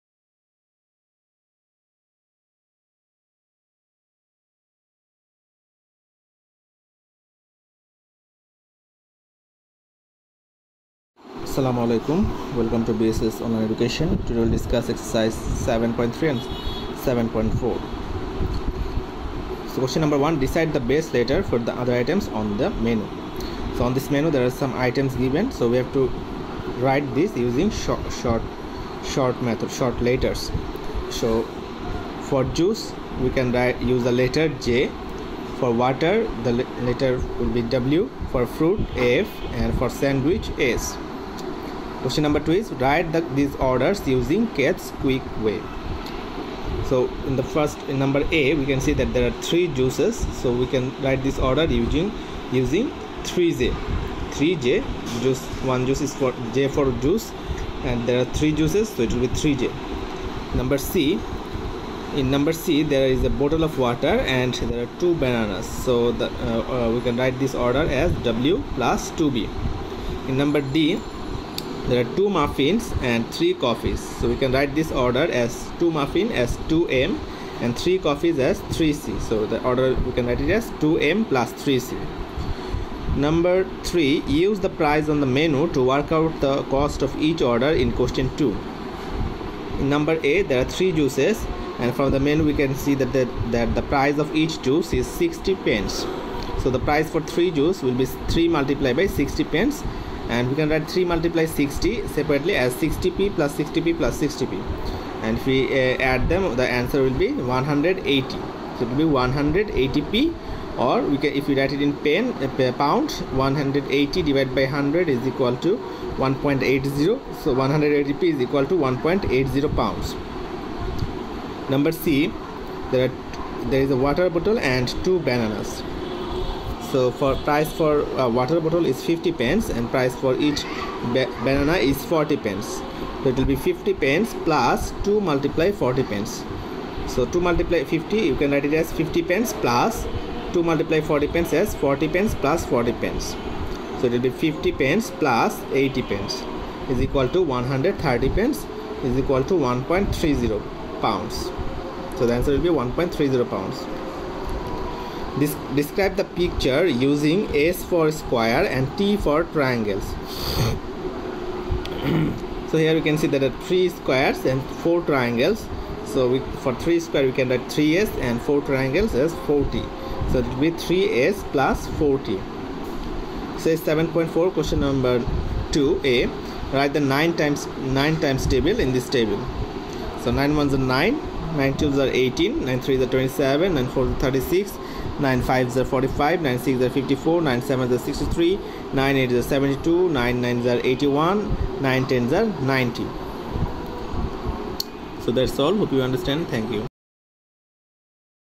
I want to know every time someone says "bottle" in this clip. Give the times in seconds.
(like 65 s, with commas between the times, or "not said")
63 s, 124 s, 128 s.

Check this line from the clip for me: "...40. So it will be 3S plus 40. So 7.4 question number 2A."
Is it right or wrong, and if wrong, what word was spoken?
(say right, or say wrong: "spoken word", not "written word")
right.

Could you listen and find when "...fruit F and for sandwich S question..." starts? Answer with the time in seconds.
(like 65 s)
38 s.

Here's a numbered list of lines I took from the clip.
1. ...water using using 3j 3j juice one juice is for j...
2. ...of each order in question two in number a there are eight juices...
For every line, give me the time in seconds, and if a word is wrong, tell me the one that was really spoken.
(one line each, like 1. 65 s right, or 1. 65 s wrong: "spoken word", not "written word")
1. 51 s wrong: "order", not "water"
2. 87 s wrong: "three", not "eight".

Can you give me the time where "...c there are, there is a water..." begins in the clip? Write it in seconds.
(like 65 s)
122 s.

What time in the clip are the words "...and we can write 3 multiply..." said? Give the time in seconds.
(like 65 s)
100 s.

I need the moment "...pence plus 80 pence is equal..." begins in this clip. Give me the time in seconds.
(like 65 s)
144 s.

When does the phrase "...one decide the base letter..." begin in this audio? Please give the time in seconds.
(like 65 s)
20 s.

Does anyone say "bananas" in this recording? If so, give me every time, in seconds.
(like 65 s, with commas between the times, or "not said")
65 s, 125 s, 131 s.